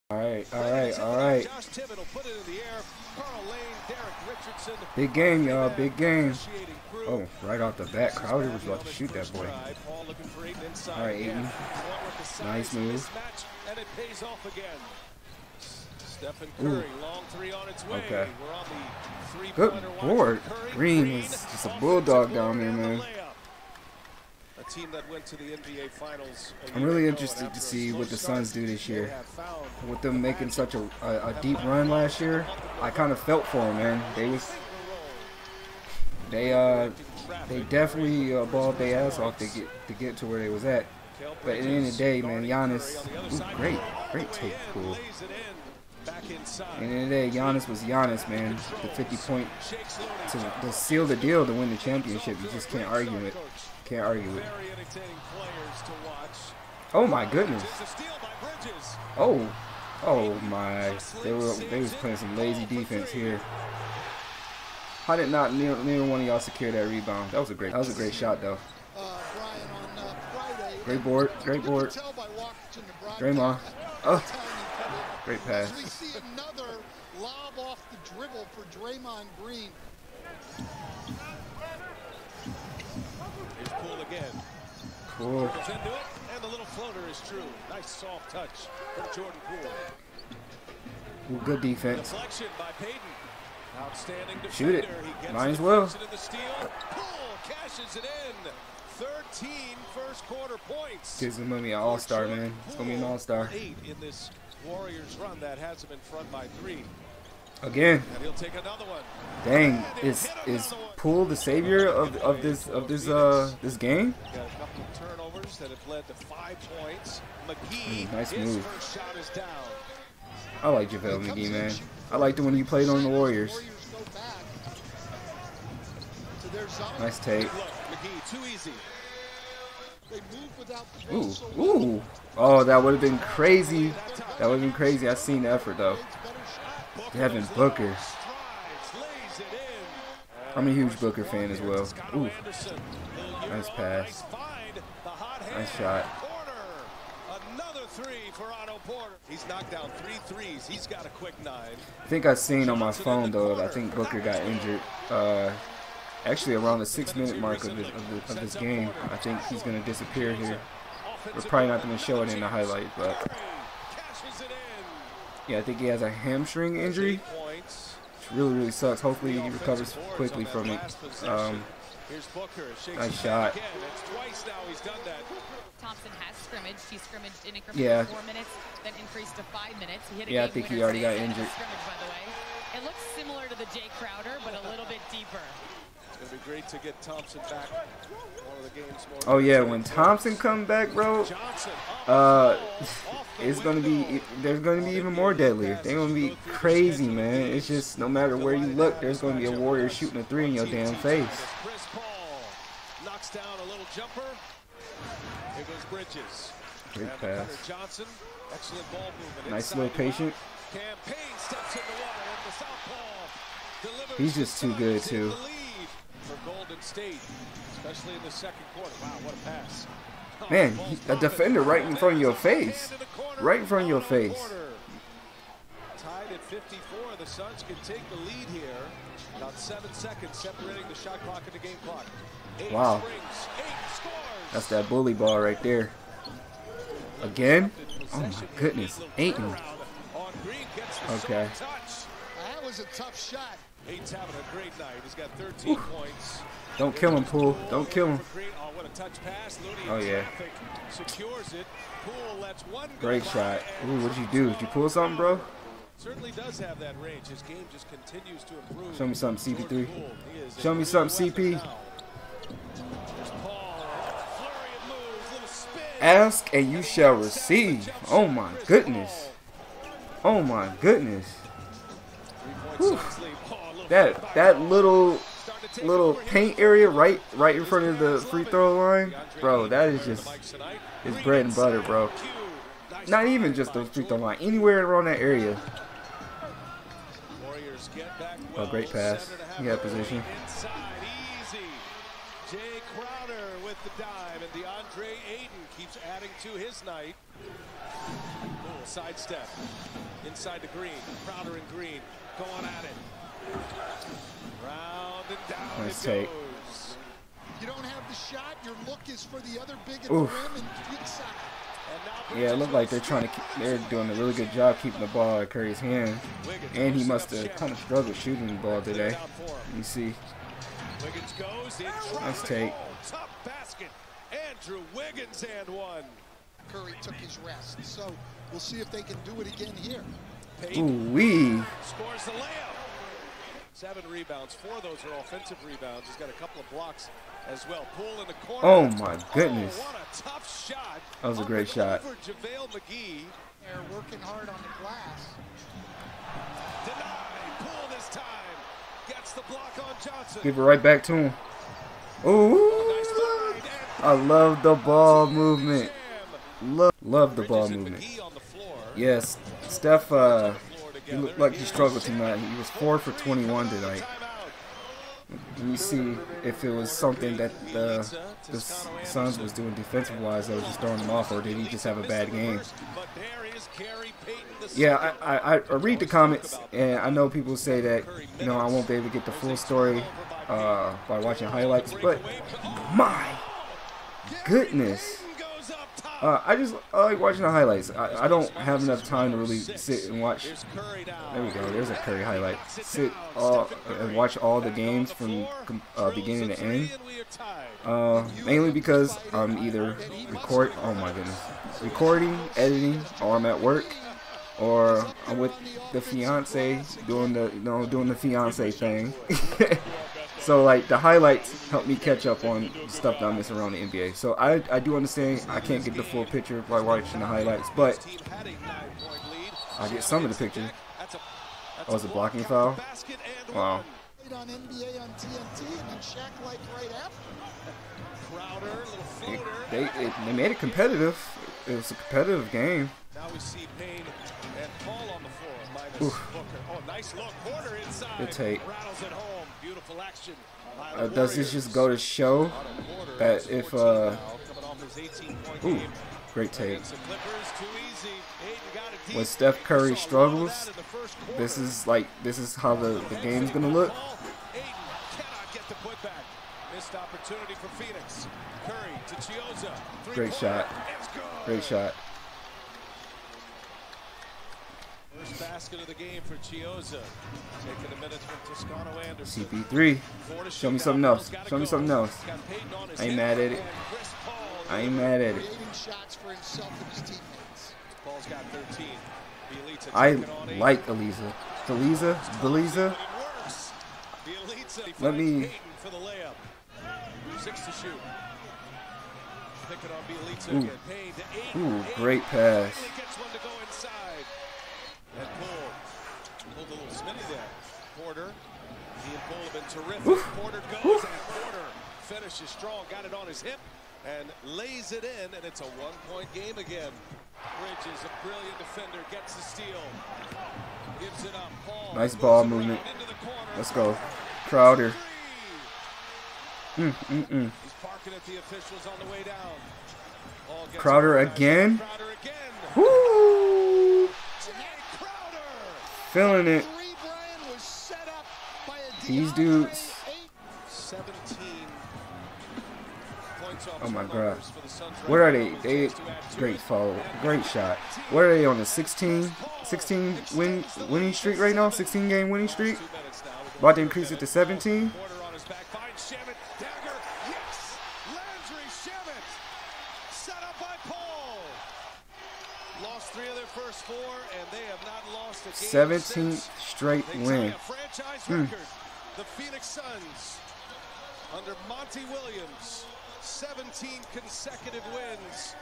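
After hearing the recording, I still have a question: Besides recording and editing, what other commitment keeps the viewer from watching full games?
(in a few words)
work.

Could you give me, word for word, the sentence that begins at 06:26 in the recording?
Uh, I just I like watching the highlights.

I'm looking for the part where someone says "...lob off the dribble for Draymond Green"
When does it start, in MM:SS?
01:17.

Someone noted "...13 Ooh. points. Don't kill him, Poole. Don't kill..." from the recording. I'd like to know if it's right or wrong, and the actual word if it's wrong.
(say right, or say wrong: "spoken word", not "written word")
right.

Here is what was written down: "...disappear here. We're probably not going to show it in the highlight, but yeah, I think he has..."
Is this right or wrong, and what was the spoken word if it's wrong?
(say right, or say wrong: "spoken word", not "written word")
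right.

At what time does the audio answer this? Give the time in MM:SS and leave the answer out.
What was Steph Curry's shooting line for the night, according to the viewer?
06:02.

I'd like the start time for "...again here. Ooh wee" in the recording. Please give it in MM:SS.
05:29.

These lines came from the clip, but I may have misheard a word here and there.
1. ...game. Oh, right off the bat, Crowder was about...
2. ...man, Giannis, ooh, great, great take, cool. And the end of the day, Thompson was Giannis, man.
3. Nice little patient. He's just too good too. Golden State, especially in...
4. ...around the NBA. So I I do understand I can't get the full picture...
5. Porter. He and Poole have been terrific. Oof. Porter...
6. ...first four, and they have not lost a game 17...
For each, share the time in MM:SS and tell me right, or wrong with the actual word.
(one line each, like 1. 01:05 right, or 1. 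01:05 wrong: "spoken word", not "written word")
1. 00:05 right
2. 00:42 wrong: "Giannis", not "Thompson"
3. 03:29 right
4. 06:53 right
5. 08:18 right
6. 09:13 right.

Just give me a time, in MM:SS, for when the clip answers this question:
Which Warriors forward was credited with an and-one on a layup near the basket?
05:24.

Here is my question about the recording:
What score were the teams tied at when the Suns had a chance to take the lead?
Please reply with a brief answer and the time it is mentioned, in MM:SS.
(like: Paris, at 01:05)
54, at 03:45.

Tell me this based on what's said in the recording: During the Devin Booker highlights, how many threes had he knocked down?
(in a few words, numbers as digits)
3.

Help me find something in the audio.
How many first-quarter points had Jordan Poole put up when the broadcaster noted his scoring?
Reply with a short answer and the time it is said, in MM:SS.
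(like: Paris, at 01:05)
13, at 01:38.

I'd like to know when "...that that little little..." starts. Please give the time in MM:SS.
04:33.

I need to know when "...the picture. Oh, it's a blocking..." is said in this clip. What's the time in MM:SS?
07:00.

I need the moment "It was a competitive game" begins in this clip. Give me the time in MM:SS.
07:11.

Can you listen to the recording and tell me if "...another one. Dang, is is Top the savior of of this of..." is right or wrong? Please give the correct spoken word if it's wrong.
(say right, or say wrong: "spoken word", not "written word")
wrong: "Poole", not "Top".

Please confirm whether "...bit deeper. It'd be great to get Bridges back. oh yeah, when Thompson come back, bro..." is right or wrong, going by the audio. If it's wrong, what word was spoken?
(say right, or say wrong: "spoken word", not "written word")
wrong: "Thompson", not "Bridges".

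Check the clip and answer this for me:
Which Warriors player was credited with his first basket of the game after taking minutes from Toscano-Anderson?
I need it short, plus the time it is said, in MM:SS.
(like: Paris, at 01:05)
Chiozza, at 07:46.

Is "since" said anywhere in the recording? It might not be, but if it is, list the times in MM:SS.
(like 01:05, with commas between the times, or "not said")
not said.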